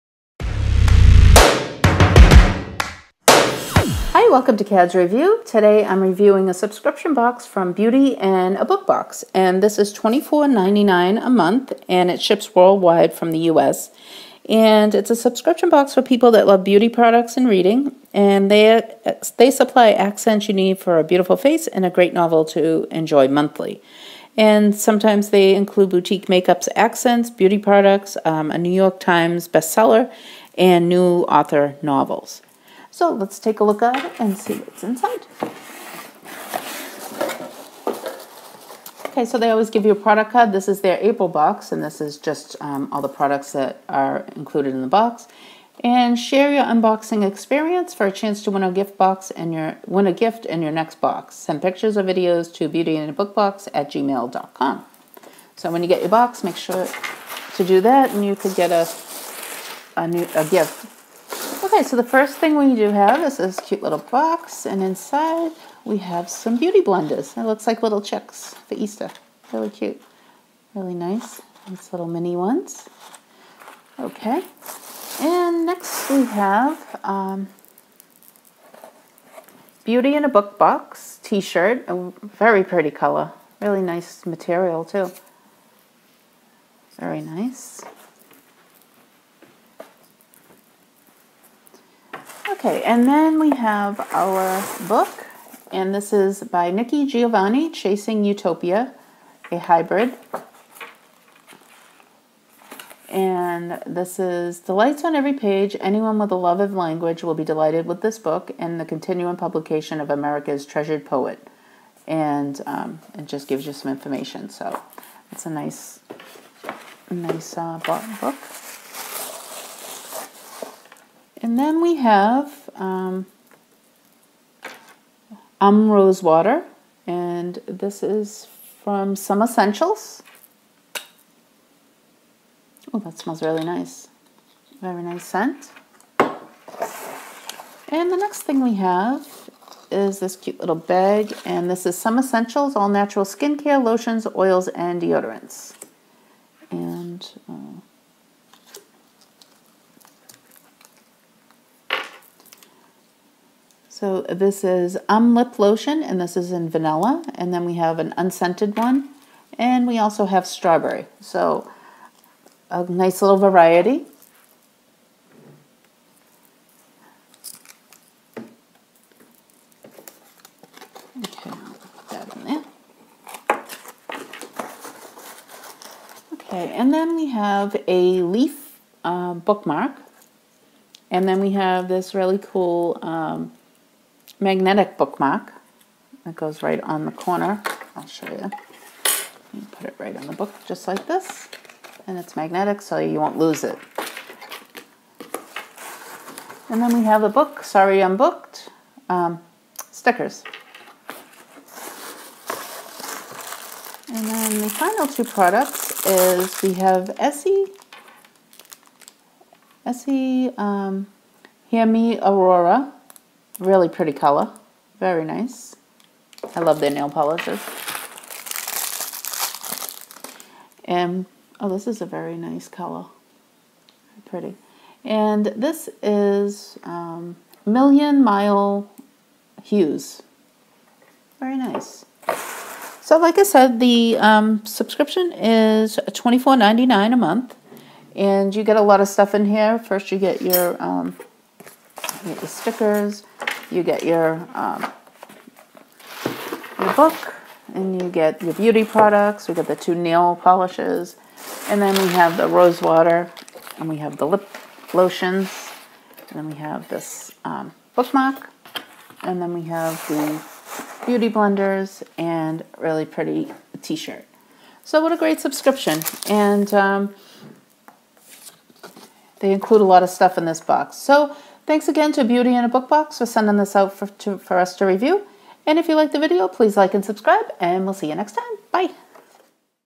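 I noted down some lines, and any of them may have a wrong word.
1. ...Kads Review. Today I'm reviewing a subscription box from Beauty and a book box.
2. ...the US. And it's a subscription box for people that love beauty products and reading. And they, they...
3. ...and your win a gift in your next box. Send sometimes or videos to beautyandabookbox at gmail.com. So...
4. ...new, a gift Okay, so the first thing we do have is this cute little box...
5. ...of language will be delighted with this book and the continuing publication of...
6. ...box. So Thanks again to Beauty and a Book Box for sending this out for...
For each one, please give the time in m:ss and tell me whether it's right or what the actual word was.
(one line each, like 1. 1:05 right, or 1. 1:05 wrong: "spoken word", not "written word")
1. 0:04 right
2. 0:13 right
3. 0:49 wrong: "pictures", not "sometimes"
4. 1:00 right
5. 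1:46 right
6. 4:30 right.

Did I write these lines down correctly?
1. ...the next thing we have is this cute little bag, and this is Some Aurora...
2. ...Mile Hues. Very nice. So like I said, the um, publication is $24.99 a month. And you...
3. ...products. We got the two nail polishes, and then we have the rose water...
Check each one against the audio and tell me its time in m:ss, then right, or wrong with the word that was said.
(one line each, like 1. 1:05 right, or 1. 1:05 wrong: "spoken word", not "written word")
1. 2:18 wrong: "Essentials", not "Aurora"
2. 3:48 wrong: "subscription", not "publication"
3. 4:08 right.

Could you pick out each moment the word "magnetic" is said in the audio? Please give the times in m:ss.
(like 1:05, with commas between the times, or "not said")
3:04, 3:12.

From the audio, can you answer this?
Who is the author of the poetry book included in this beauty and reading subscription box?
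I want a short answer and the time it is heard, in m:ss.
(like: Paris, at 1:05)
Nikki Giovanni, at 1:36.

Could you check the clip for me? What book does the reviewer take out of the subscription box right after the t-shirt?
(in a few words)
Chasing Utopia.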